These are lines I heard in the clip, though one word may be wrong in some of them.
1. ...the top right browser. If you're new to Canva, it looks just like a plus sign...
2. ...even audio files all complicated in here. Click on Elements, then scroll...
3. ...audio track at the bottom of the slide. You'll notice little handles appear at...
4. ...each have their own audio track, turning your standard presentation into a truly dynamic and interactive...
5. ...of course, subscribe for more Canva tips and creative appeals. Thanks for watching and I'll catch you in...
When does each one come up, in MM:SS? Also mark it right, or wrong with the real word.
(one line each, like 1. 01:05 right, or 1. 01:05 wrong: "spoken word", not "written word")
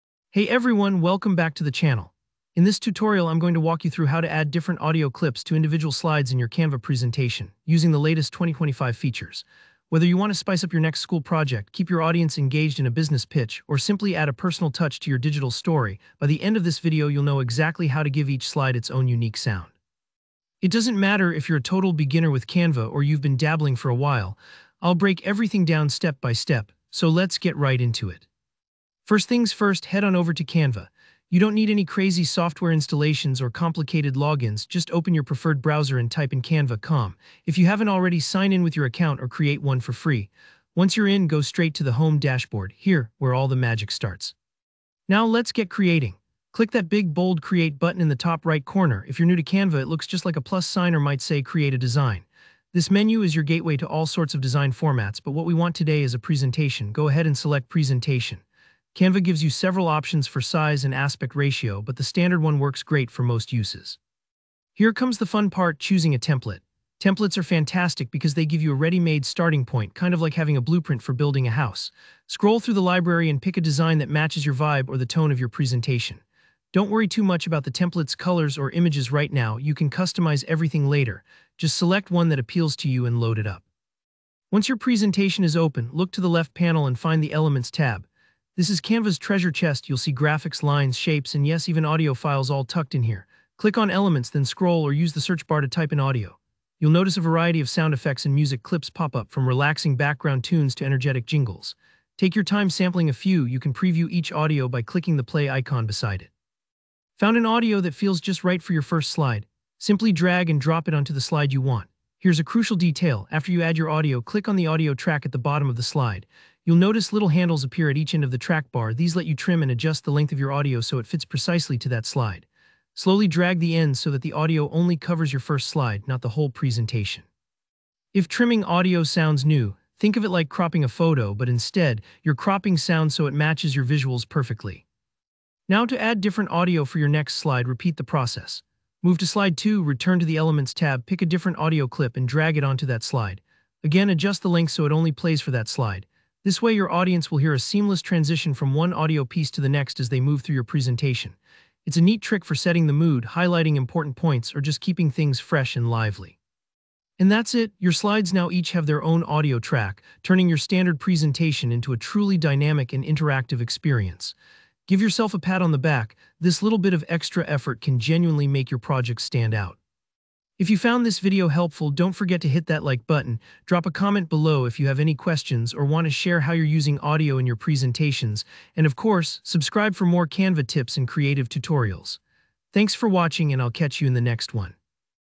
1. 00:48 wrong: "corner", not "browser"
2. 01:31 wrong: "tucked", not "complicated"
3. 01:54 right
4. 02:38 right
5. 02:58 wrong: "tutorials", not "appeals".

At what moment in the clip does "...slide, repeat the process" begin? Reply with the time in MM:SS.
02:17.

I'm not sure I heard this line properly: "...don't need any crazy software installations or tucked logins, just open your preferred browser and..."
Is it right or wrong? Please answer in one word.
wrong.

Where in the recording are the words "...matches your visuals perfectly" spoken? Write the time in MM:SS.
02:13.